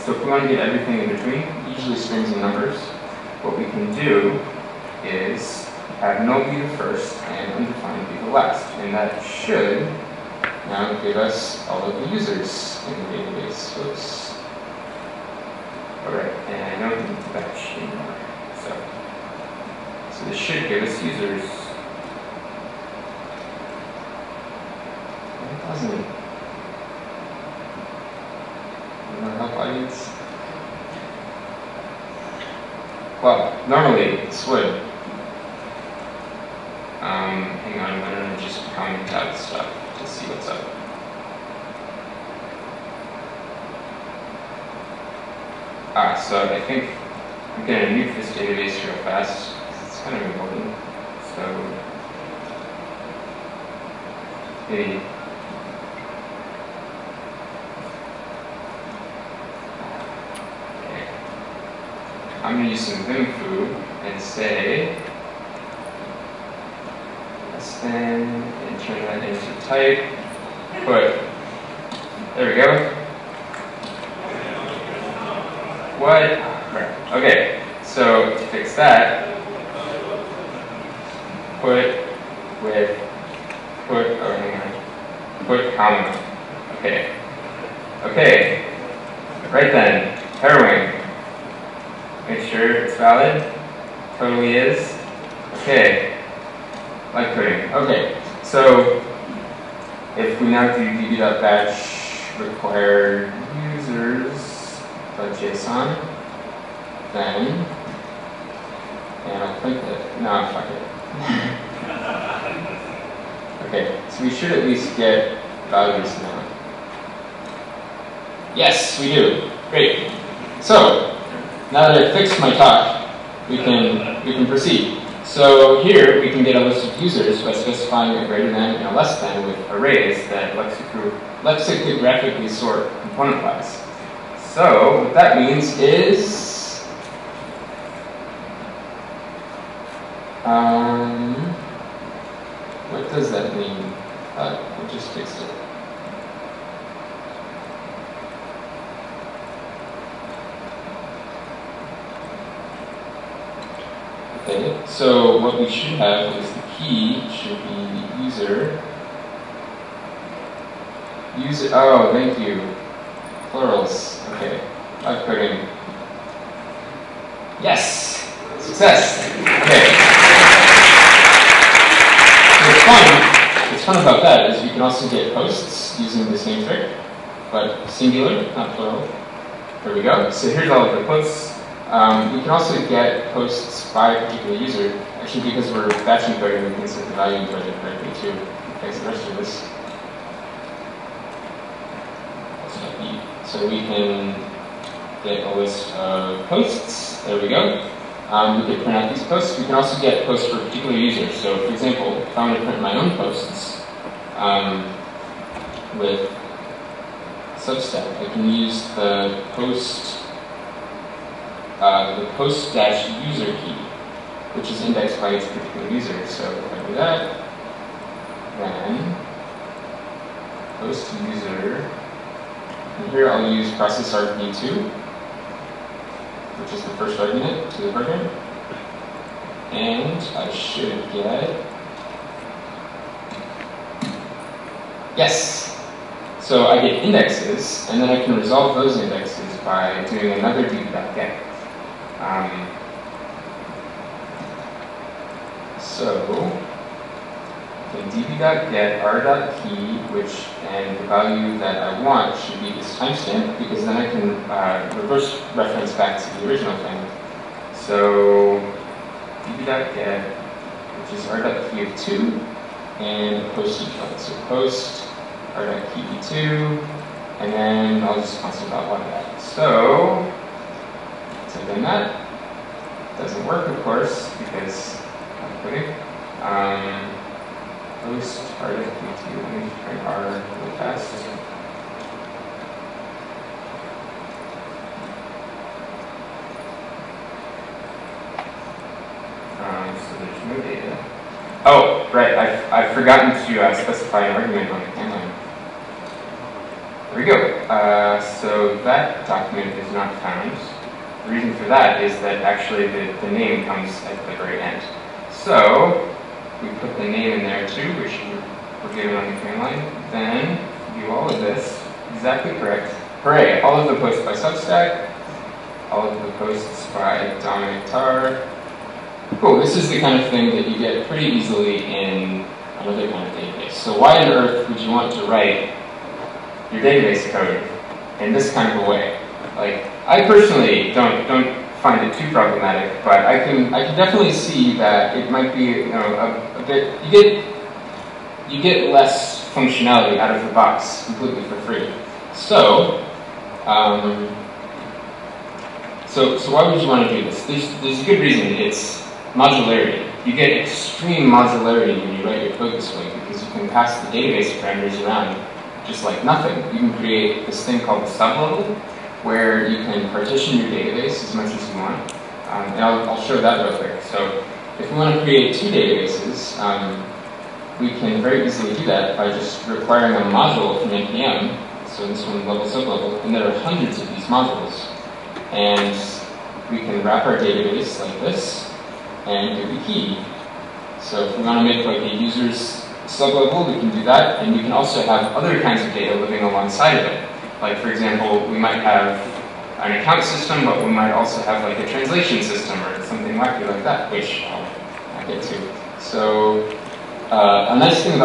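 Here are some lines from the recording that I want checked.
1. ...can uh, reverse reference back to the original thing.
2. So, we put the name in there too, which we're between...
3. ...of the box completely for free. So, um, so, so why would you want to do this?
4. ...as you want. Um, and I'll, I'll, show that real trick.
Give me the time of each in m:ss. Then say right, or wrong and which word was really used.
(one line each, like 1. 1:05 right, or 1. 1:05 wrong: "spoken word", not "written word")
1. 4:14 right
2. 5:05 wrong: "given", not "between"
3. 5:40 right
4. 6:01 wrong: "quick", not "trick".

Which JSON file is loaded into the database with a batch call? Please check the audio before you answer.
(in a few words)
users.json.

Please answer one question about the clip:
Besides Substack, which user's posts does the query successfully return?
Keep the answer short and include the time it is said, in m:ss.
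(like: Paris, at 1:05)
Dominic Tarr, at 5:17.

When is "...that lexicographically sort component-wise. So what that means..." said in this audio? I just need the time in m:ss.
2:10.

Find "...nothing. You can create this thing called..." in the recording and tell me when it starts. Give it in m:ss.
5:56.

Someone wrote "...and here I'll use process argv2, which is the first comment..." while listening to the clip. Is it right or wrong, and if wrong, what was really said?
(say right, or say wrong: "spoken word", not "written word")
wrong: "argument", not "comment".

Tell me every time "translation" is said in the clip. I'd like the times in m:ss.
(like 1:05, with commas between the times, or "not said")
6:31.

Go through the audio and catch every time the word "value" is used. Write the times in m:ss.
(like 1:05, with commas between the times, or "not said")
1:55, 3:07, 4:11.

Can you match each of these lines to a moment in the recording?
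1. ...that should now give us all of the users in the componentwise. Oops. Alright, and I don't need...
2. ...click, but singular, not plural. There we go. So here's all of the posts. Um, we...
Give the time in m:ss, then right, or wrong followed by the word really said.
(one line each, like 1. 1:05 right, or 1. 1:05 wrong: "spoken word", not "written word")
1. 0:08 wrong: "database", not "componentwise"
2. 2:56 wrong: "trick", not "click".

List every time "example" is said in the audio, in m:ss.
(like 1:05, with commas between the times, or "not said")
3:21, 6:27.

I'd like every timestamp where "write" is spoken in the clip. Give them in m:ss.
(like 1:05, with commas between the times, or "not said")
5:25, 5:52.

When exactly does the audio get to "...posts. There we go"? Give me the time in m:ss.
3:16.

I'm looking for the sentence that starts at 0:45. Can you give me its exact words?
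Ah, so I think I'm gonna nuke this database real fast, because it's kind of important.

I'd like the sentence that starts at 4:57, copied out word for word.
Uh, so that document is not found.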